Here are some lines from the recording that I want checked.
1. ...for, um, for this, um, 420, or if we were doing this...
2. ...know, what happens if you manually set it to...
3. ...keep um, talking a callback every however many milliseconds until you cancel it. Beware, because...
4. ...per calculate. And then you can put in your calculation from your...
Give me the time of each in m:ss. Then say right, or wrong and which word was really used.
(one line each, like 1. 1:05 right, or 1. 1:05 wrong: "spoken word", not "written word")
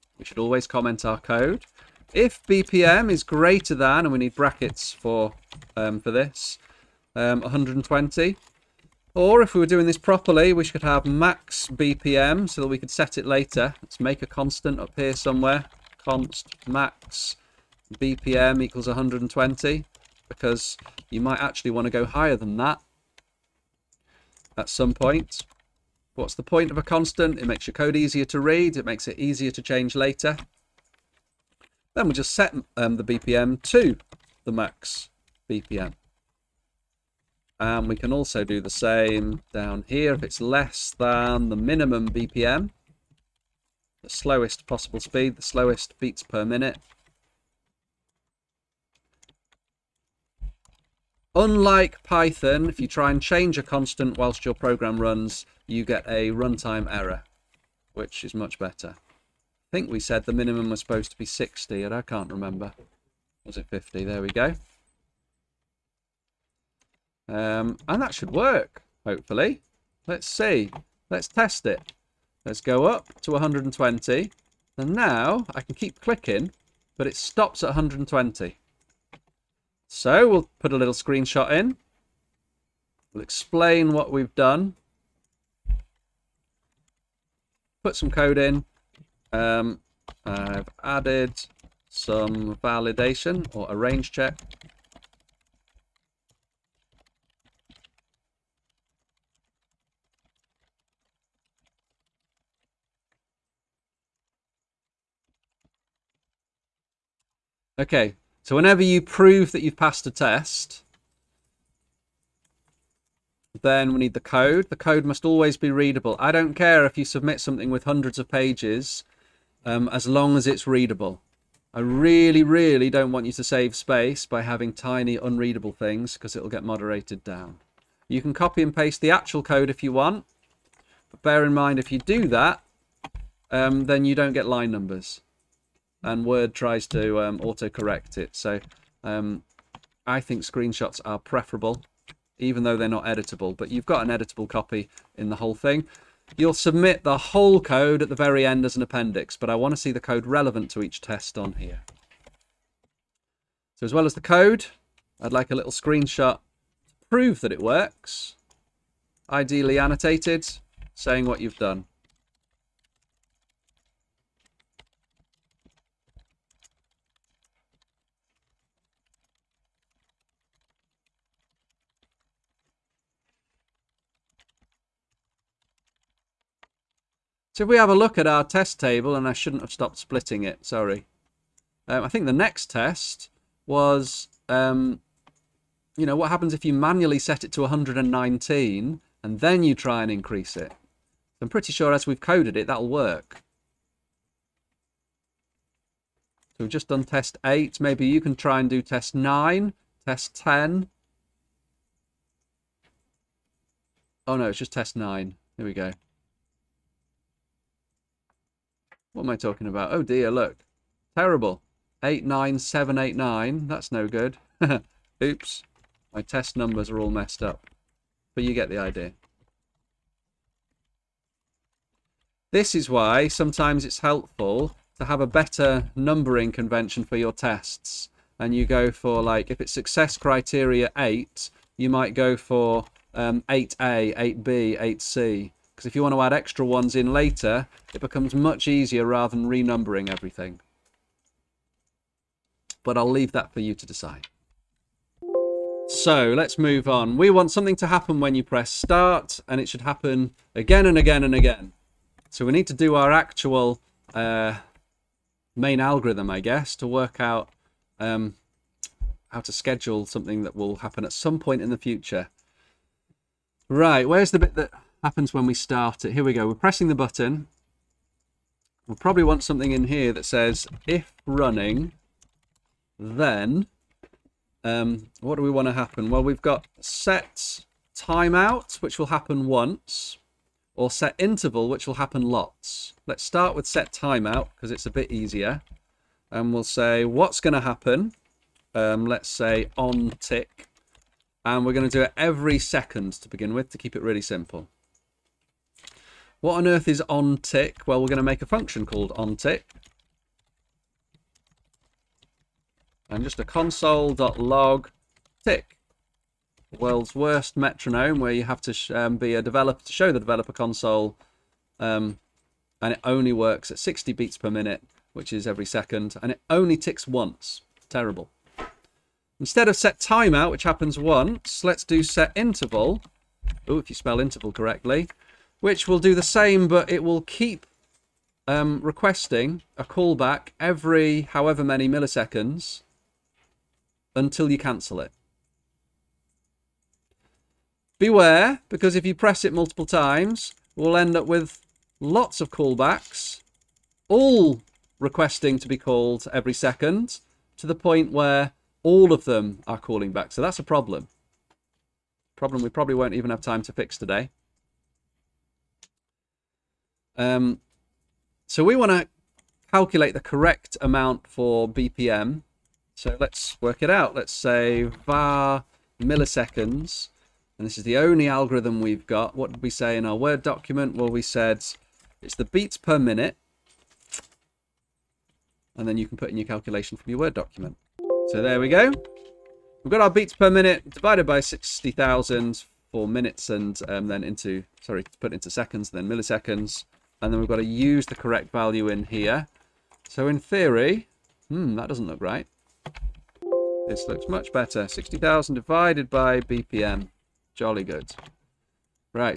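1. 0:04 wrong: "120", not "420"
2. 3:06 right
3. 5:27 wrong: "requesting", not "talking"
4. 6:12 wrong: "minute", not "calculate".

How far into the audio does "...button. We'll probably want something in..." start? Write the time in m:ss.
4:26.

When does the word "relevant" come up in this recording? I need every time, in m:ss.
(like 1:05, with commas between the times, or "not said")
2:30.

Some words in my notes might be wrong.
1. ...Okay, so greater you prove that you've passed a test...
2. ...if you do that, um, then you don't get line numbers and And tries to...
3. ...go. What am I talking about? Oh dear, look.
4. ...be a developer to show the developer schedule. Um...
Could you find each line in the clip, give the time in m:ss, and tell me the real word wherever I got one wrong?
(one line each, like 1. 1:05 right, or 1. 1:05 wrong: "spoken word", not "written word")
1. 1:47 wrong: "whenever", not "greater"
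2. 2:11 wrong: "Word", not "And"
3. 3:25 right
4. 5:09 wrong: "console", not "schedule".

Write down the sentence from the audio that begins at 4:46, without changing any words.
And we'll say what's going to happen.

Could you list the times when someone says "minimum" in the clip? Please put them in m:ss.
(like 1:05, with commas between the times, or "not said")
0:41, 1:00.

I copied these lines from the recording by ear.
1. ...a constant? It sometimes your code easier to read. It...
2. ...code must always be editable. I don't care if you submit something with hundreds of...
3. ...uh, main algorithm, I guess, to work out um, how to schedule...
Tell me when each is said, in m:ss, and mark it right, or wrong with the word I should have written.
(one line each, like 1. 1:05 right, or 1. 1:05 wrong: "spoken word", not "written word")
1. 0:26 wrong: "makes", not "sometimes"
2. 1:54 wrong: "readable", not "editable"
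3. 4:14 right.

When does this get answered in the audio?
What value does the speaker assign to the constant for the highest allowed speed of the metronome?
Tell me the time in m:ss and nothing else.
0:16.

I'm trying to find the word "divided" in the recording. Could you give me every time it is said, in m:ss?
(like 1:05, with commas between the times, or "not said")
6:20, 6:35.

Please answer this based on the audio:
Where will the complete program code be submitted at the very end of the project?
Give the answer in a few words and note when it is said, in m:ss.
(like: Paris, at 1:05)
an appendix, at 2:28.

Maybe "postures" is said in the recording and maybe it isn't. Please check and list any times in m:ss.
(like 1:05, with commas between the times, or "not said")
not said.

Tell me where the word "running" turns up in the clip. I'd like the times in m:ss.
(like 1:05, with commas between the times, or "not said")
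4:31.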